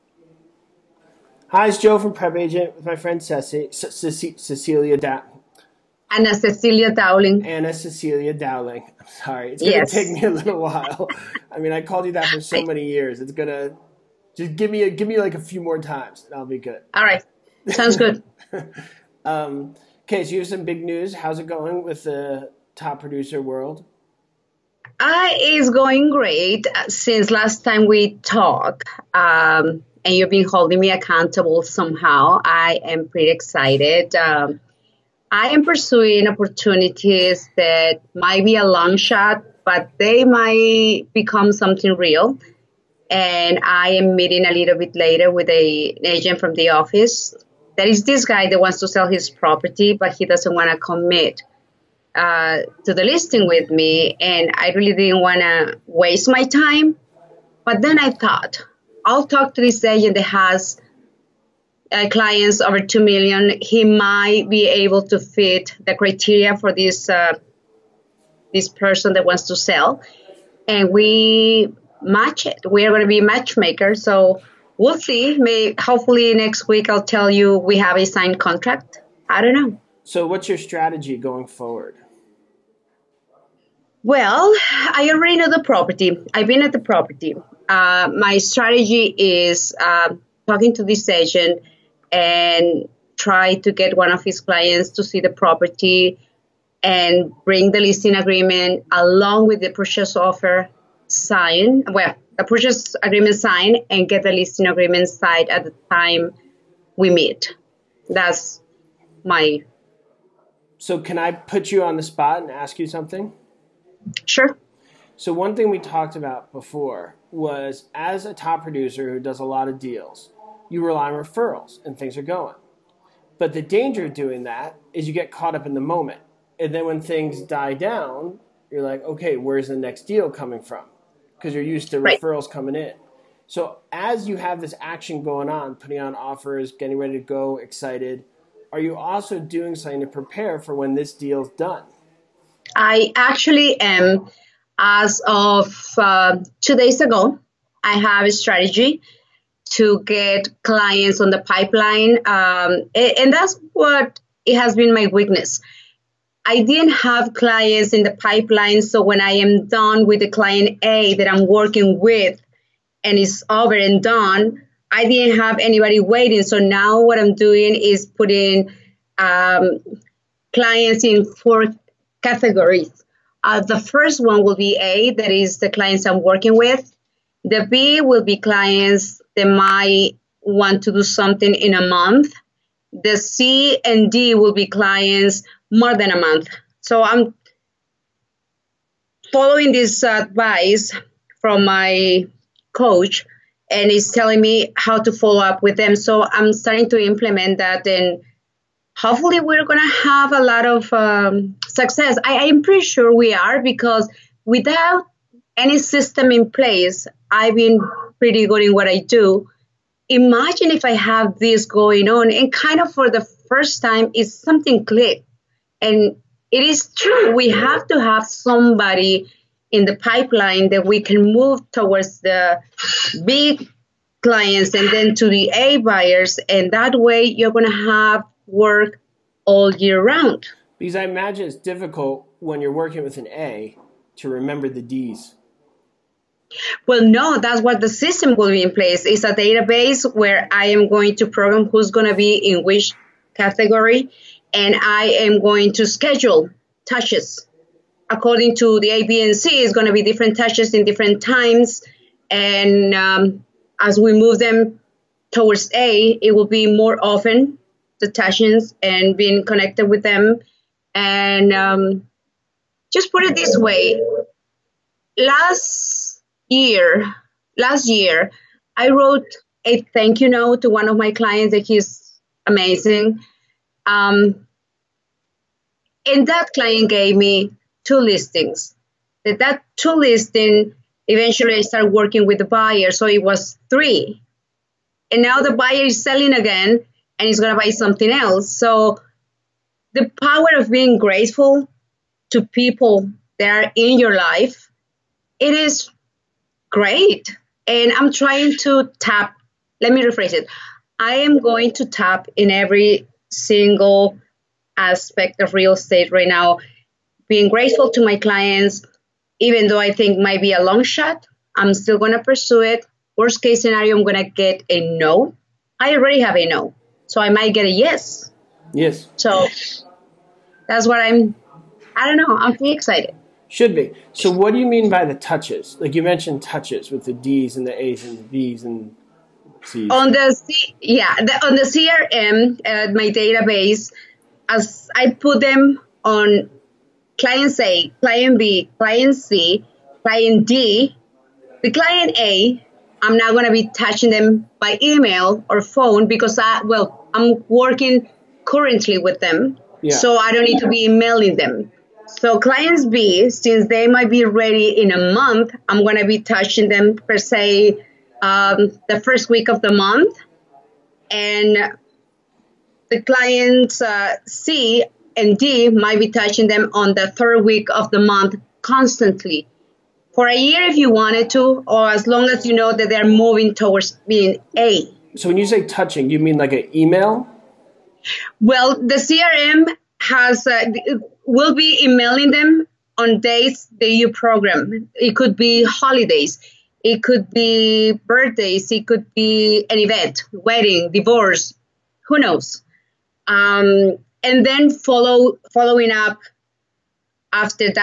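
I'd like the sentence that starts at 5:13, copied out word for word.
Worst case scenario, I'm going to get a no.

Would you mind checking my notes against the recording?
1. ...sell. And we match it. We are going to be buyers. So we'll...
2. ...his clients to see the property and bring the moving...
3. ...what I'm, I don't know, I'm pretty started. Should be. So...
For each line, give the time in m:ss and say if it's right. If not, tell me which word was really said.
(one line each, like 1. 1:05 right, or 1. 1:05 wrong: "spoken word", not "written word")
1. 1:09 wrong: "matchmakers", not "buyers"
2. 1:34 wrong: "listing", not "moving"
3. 5:20 wrong: "excited", not "started".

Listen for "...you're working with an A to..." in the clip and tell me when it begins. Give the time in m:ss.
3:52.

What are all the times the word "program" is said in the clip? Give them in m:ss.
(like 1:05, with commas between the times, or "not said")
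4:01, 6:24.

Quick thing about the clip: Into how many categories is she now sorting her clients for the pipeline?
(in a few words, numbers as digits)
4.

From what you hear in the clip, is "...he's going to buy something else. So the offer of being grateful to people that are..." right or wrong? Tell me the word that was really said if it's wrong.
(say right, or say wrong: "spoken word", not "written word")
wrong: "power", not "offer".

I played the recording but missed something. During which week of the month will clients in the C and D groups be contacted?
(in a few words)
third week.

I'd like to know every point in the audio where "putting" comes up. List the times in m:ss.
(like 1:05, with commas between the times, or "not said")
2:15, 2:48.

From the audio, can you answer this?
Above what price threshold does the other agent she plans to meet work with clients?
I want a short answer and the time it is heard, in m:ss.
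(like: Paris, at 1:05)
2 million, at 1:02.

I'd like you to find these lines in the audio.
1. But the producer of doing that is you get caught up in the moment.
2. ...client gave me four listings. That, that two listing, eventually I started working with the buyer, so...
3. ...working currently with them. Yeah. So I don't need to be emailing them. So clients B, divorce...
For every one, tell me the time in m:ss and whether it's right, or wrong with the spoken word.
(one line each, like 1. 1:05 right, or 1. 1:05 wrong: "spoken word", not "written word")
1. 2:03 wrong: "danger", not "producer"
2. 4:36 wrong: "two", not "four"
3. 5:47 wrong: "since", not "divorce".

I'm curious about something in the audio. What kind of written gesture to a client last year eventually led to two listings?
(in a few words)
thank you note.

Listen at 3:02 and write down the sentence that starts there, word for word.
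The C and D will be clients more than a month.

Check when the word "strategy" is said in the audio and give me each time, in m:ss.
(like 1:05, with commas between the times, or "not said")
1:20, 1:28, 2:28.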